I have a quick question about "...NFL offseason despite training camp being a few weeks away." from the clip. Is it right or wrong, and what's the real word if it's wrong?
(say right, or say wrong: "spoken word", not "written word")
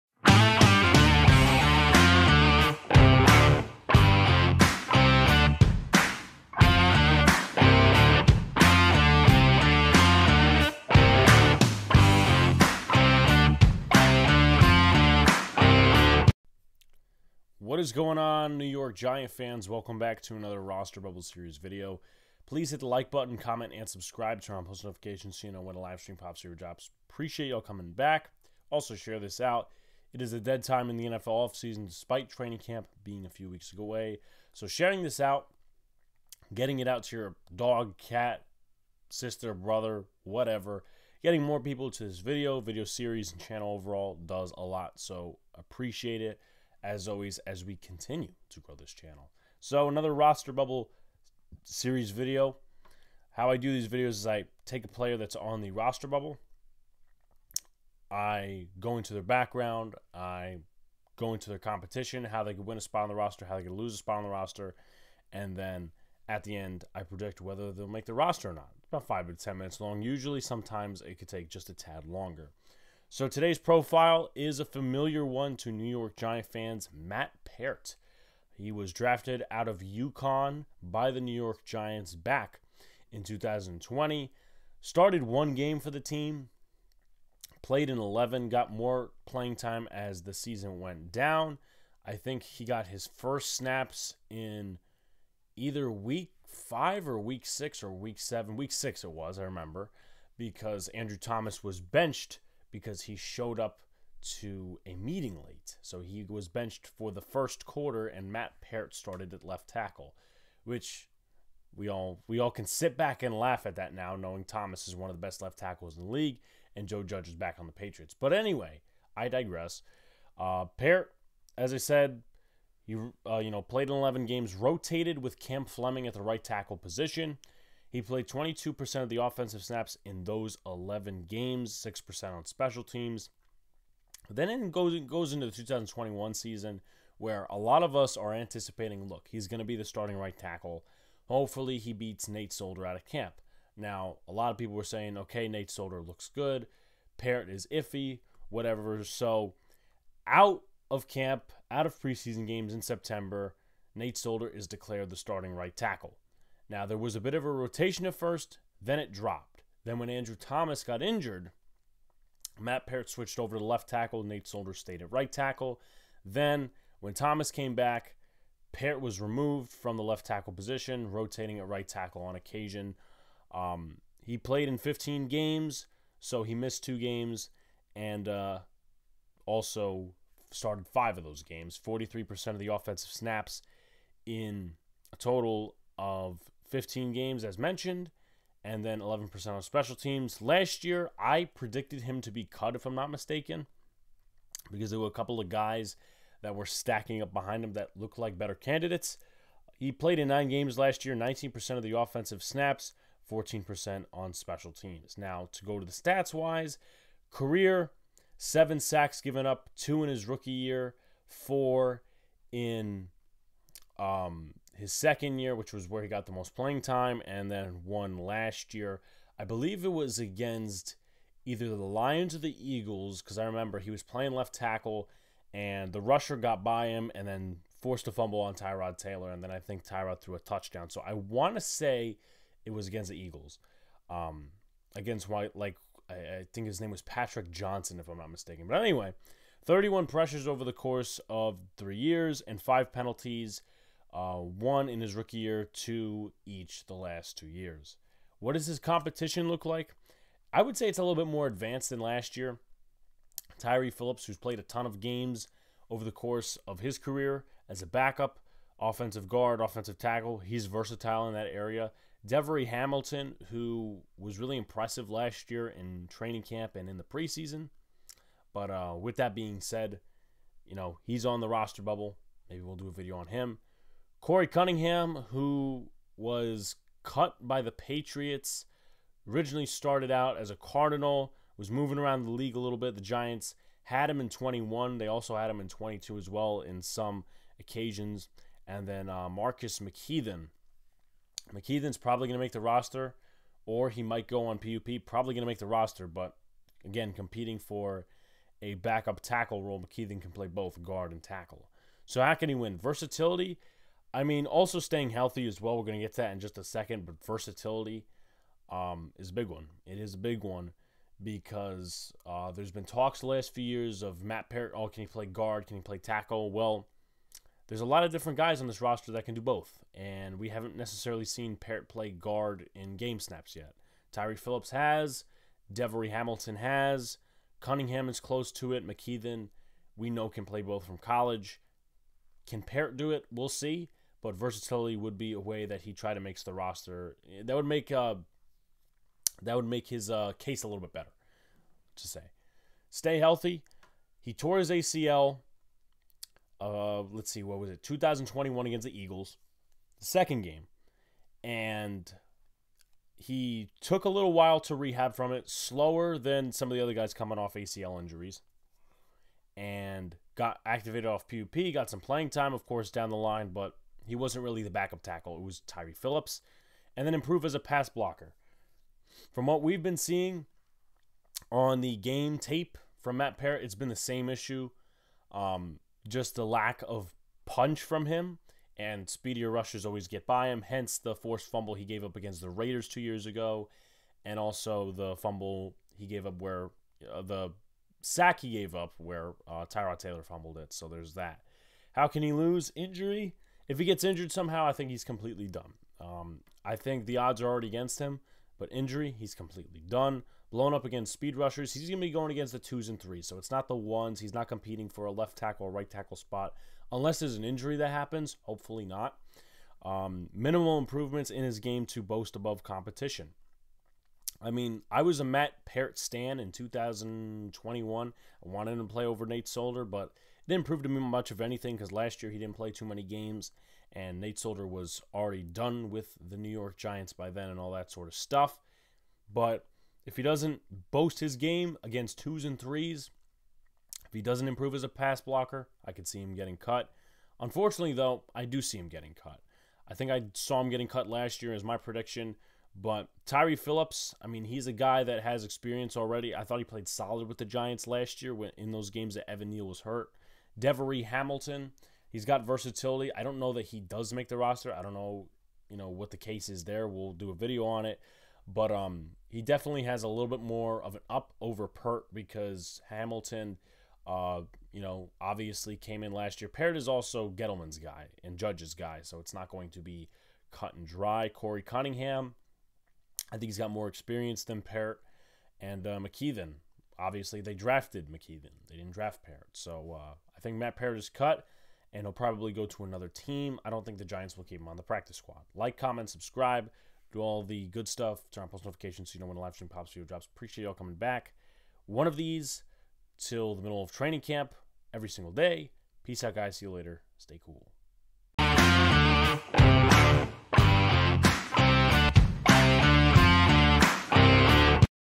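right.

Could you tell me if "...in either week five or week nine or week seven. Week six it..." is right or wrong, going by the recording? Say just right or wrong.
wrong.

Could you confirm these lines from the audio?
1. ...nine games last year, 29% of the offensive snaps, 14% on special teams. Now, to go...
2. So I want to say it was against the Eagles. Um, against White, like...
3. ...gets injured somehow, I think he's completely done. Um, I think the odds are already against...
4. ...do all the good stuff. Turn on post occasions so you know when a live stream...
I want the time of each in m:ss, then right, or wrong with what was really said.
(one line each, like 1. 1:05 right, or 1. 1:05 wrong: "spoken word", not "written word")
1. 3:20 wrong: "19", not "29"
2. 3:50 right
3. 6:33 right
4. 8:07 wrong: "notifications", not "occasions".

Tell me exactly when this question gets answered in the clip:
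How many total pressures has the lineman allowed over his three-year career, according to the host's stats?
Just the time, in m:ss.
3:59.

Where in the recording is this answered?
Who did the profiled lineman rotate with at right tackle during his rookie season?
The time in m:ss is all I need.
2:05.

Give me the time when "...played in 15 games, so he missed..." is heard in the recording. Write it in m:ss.
2:54.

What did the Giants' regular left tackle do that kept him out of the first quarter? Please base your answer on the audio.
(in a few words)
showed up to a meeting late.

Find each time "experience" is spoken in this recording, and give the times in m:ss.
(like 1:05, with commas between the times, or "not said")
7:25, 7:53.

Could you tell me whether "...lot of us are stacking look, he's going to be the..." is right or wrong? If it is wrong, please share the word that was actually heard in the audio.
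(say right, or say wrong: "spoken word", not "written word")
wrong: "anticipating", not "stacking".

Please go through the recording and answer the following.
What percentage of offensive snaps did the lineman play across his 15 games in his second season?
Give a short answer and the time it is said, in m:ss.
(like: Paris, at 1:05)
43%, at 3:01.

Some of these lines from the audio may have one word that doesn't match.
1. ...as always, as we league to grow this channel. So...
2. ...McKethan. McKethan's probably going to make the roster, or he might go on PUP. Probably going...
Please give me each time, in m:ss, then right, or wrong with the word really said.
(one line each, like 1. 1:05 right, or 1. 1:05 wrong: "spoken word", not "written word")
1. 0:46 wrong: "continue", not "league"
2. 4:49 right.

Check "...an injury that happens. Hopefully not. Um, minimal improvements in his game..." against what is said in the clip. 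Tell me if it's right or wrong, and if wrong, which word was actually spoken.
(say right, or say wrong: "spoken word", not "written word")
right.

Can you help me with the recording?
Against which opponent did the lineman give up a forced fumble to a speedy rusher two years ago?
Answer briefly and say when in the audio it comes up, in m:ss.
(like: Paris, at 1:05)
Raiders, at 6:22.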